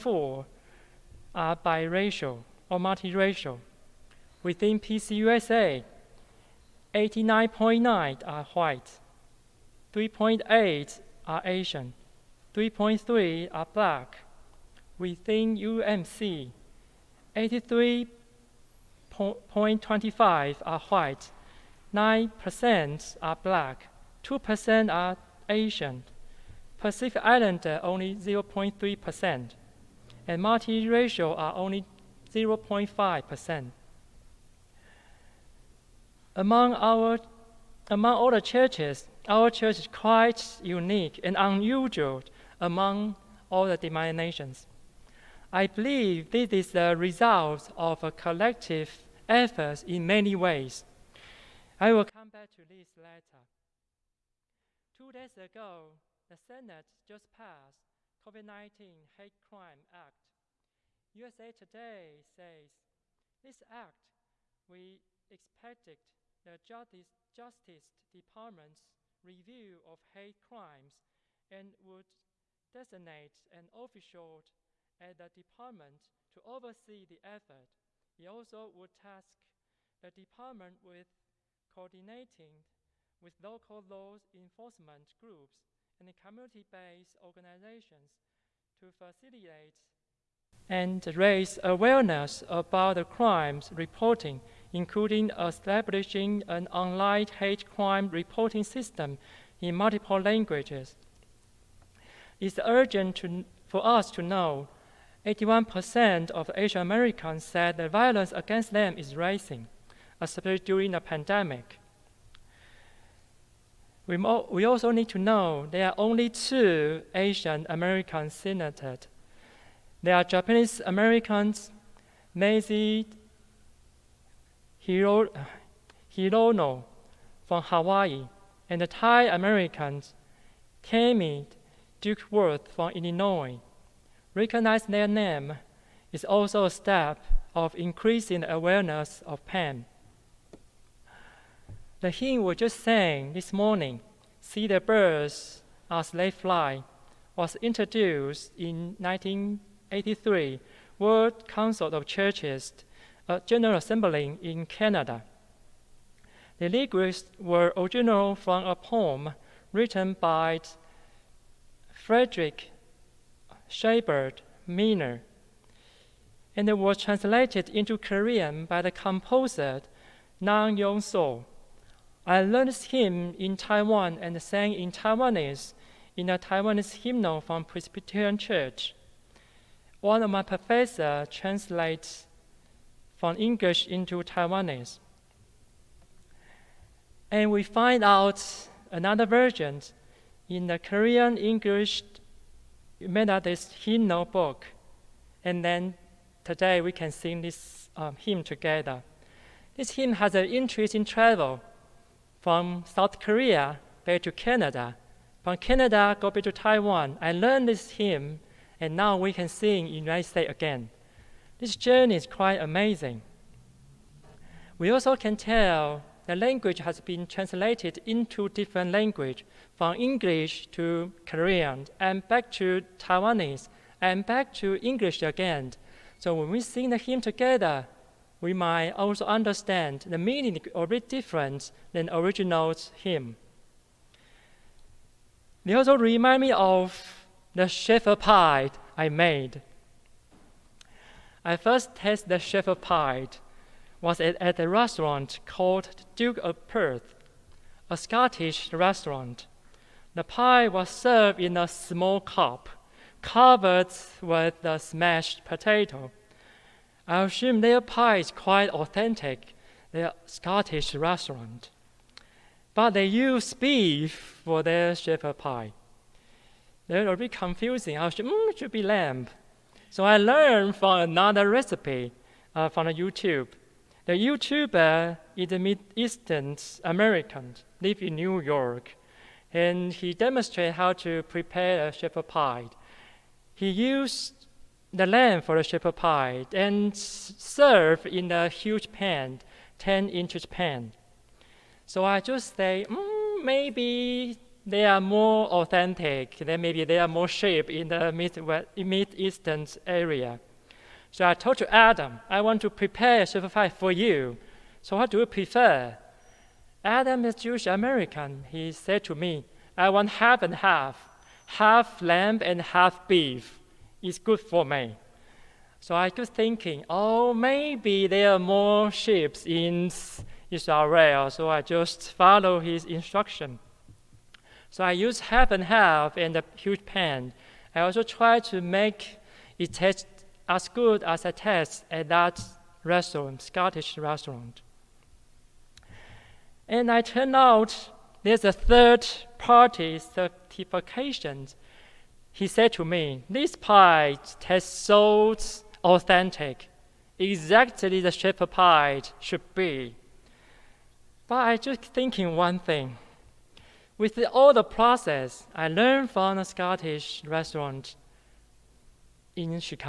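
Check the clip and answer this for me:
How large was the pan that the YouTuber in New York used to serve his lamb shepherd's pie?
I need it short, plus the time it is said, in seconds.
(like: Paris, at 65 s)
10 inches, at 289 s.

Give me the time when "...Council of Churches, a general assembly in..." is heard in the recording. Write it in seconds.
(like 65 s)
151 s.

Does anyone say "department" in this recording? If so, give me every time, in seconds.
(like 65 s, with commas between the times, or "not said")
68 s, 75 s, 80 s.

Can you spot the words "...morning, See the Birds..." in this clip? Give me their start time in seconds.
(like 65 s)
143 s.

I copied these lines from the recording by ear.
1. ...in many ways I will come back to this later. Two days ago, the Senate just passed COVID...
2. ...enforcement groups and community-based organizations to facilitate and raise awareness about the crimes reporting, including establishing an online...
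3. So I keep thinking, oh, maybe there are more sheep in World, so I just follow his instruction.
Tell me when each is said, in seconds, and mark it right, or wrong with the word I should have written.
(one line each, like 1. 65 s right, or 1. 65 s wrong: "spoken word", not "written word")
1. 49 s right
2. 84 s right
3. 315 s wrong: "Israel", not "World".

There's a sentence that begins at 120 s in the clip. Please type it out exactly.
There are Japanese Americans, Mazie Hiro, Hirono from Hawaii, and the Thai Americans, Tammy Duckworth from Illinois.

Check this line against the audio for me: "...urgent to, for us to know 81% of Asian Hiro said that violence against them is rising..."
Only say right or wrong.
wrong.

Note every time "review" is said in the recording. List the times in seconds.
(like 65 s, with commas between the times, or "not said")
69 s.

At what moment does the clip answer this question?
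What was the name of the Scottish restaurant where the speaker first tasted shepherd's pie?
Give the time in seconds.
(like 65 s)
246 s.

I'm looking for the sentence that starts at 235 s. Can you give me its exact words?
They also remind me of the shepherd pie I made.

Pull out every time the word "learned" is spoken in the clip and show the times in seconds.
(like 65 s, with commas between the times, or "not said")
172 s, 207 s, 270 s, 355 s.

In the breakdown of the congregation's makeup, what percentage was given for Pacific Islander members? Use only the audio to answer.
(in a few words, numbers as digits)
0.3%.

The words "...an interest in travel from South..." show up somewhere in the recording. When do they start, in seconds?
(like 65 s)
200 s.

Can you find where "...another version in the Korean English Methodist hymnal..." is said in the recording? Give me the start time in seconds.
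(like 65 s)
188 s.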